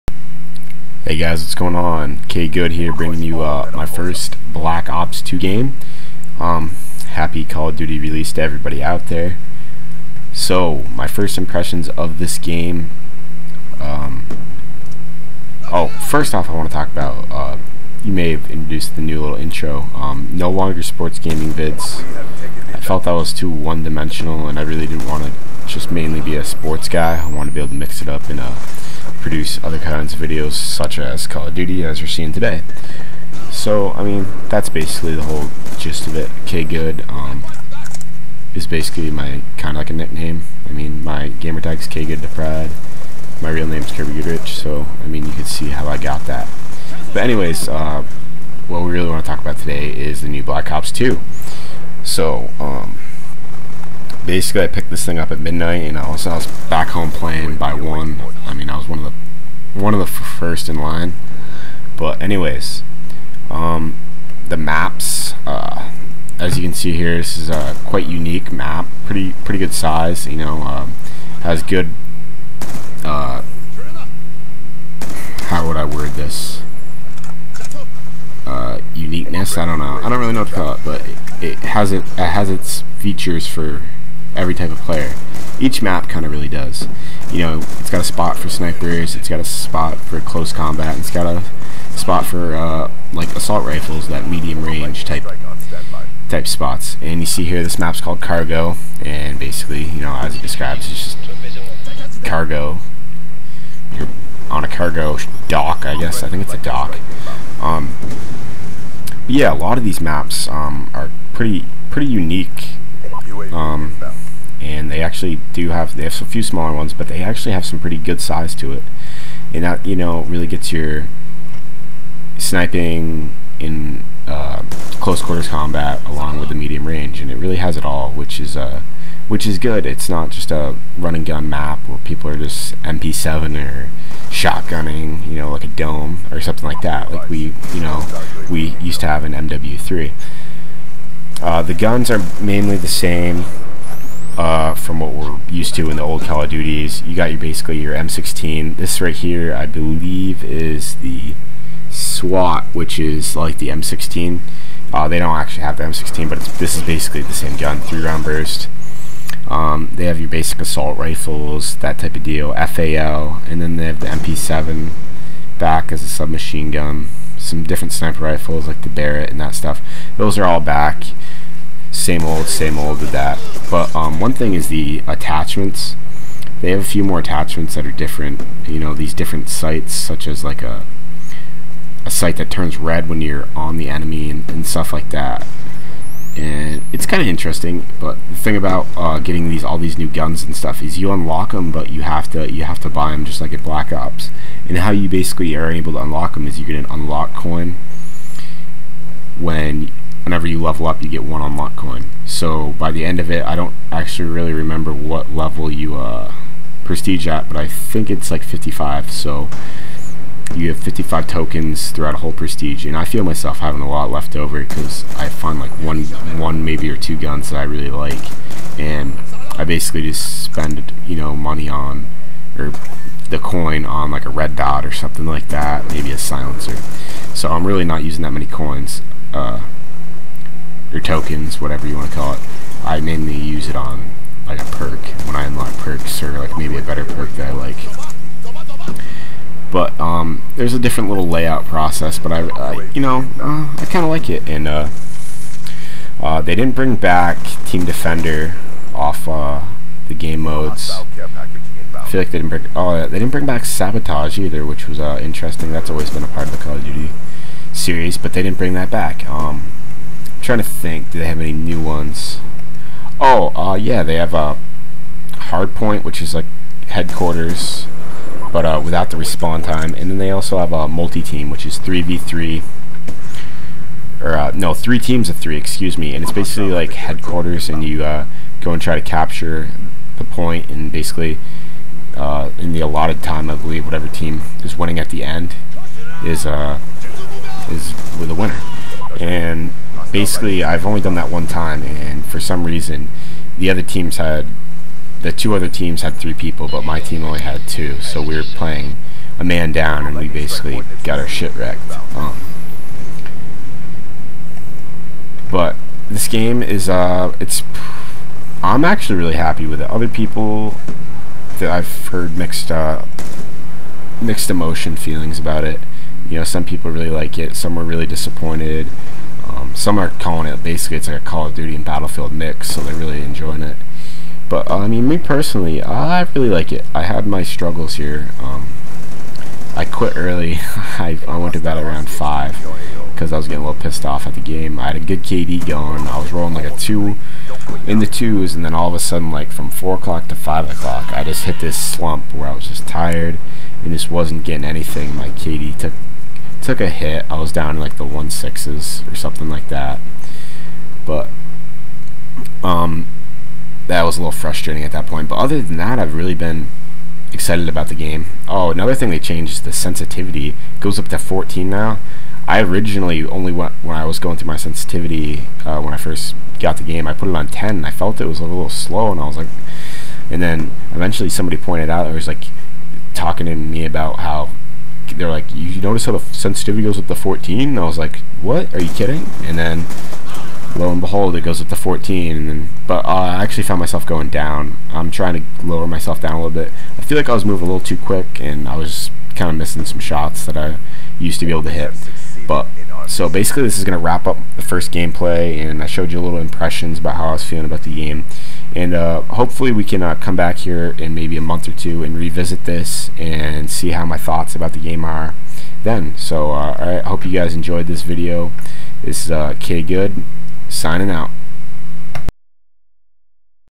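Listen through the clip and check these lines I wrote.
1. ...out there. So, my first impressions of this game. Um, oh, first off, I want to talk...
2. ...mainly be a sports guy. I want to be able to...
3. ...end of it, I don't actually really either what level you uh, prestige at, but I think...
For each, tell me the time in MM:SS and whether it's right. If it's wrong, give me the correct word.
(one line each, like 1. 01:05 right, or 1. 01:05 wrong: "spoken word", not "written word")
1. 00:08 right
2. 00:25 right
3. 03:23 wrong: "remember", not "either".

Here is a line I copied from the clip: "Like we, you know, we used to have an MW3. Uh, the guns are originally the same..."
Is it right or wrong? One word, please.
wrong.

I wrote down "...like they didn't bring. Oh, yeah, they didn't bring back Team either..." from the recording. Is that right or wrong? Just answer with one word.
wrong.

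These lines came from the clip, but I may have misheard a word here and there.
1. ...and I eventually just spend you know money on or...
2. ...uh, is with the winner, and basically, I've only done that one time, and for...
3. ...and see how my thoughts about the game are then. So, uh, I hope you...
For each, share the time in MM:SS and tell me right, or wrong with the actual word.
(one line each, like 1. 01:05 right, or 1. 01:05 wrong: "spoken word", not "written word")
1. 03:38 wrong: "basically", not "eventually"
2. 04:46 right
3. 06:43 right.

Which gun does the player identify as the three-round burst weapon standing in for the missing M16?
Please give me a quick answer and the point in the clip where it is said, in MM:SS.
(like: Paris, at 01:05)
SWAT, at 02:31.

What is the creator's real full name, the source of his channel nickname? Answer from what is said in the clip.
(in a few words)
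Kirby Goodrich.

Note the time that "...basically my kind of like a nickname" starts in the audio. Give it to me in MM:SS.
00:38.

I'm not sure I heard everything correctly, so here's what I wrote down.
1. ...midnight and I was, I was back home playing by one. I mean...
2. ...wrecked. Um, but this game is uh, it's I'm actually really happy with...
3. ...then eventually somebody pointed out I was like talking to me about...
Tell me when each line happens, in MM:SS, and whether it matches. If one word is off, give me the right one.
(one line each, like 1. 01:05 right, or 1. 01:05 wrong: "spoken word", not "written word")
1. 00:55 right
2. 05:01 right
3. 06:10 right.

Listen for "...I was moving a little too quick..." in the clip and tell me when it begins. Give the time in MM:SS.
06:27.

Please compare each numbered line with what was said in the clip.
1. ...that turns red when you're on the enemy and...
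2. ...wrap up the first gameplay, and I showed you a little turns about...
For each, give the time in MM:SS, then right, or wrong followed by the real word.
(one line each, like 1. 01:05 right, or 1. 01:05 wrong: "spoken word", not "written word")
1. 03:02 right
2. 06:34 wrong: "impressions", not "turns".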